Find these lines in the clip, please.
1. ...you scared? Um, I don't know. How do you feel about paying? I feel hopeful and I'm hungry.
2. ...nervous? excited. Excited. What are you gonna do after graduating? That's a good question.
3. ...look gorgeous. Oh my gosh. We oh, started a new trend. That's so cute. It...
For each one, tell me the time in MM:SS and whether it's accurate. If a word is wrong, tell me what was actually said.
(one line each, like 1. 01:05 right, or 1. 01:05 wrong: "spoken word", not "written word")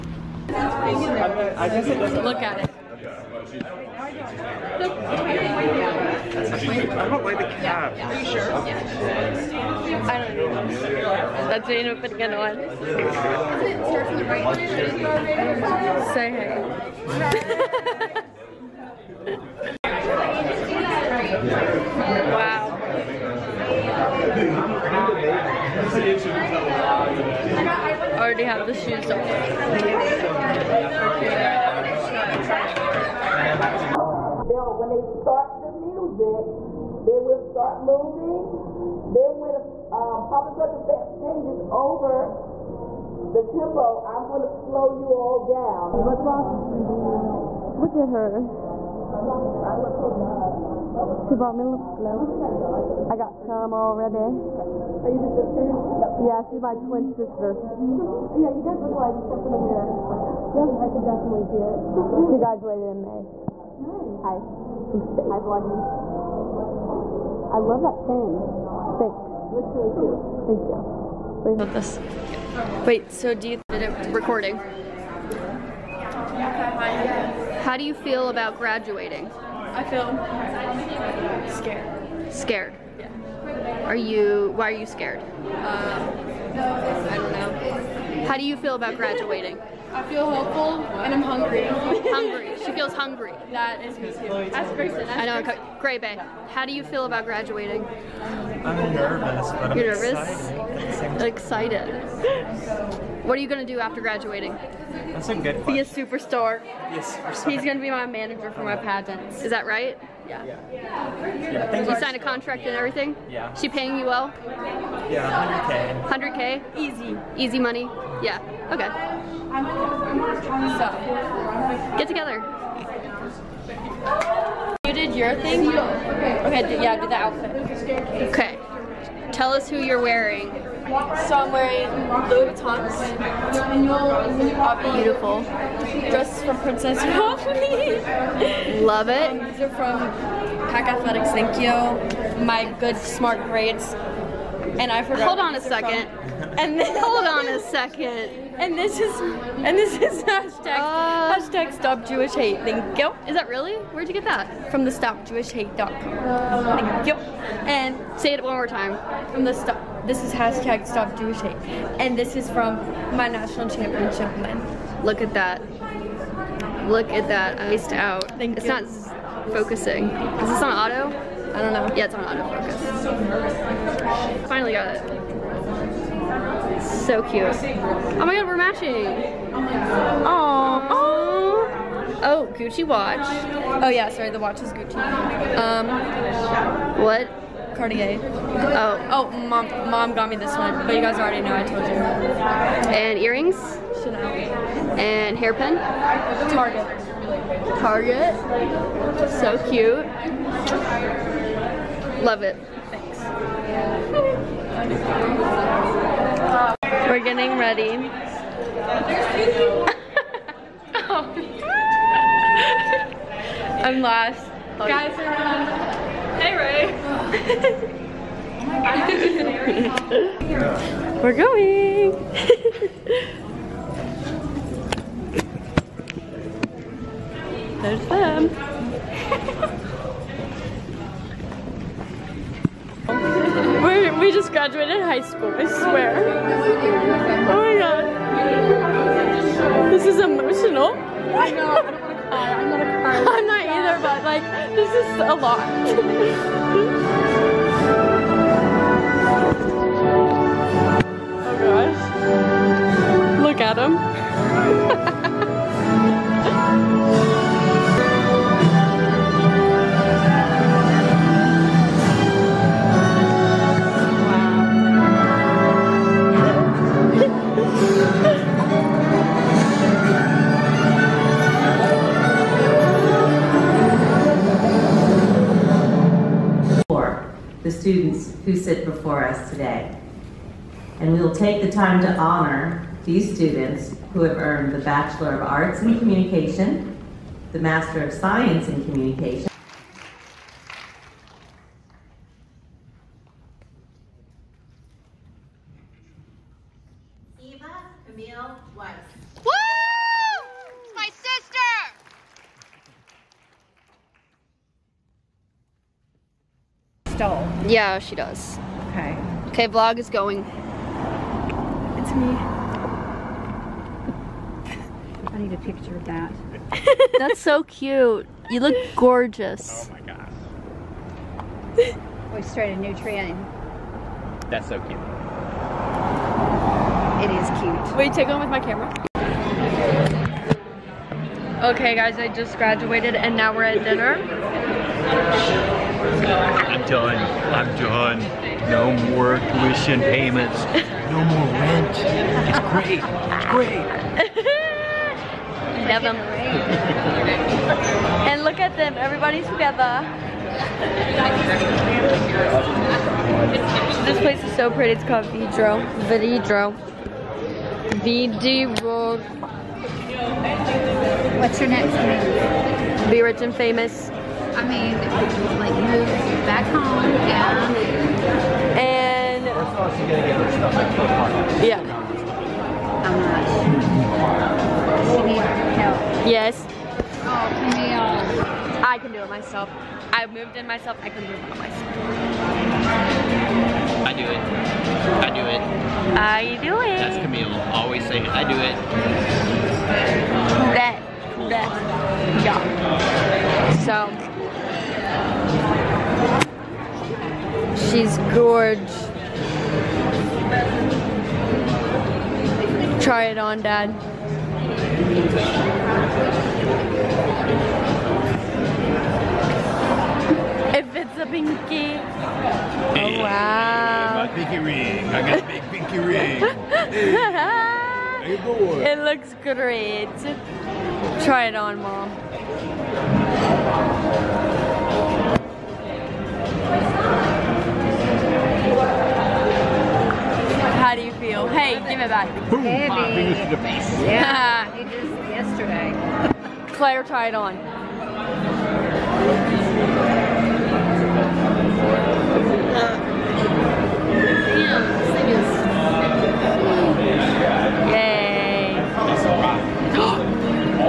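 1. 01:24 wrong: "graduating", not "paying"
2. 01:40 right
3. 05:18 right.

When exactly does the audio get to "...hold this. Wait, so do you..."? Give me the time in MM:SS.
01:11.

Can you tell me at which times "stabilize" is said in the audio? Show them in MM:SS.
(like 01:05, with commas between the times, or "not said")
not said.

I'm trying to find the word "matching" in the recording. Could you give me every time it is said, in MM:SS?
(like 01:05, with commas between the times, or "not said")
02:58.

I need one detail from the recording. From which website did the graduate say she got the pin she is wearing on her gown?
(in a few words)
stopjewishhate.com.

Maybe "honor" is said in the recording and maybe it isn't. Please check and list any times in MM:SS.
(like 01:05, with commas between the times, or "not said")
04:42.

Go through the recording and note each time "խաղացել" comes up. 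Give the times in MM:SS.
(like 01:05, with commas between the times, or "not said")
not said.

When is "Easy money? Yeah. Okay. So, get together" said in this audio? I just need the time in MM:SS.
01:57.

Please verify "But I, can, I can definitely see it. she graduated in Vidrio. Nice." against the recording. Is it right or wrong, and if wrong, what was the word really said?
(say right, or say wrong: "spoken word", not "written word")
wrong: "May", not "Vidrio".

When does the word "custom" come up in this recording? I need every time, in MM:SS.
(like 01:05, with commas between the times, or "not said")
not said.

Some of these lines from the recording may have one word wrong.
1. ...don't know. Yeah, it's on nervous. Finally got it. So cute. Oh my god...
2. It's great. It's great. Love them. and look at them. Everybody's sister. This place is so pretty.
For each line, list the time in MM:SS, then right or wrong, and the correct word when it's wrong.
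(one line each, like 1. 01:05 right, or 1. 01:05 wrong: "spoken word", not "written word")
1. 02:51 wrong: "autofocus", not "nervous"
2. 05:42 wrong: "together", not "sister".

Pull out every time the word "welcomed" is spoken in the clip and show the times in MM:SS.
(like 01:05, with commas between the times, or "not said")
not said.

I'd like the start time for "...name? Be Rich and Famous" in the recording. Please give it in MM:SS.
06:01.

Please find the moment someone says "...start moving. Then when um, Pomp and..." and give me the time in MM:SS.
00:37.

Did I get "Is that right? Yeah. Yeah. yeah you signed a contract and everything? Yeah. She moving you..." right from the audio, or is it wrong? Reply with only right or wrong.
wrong.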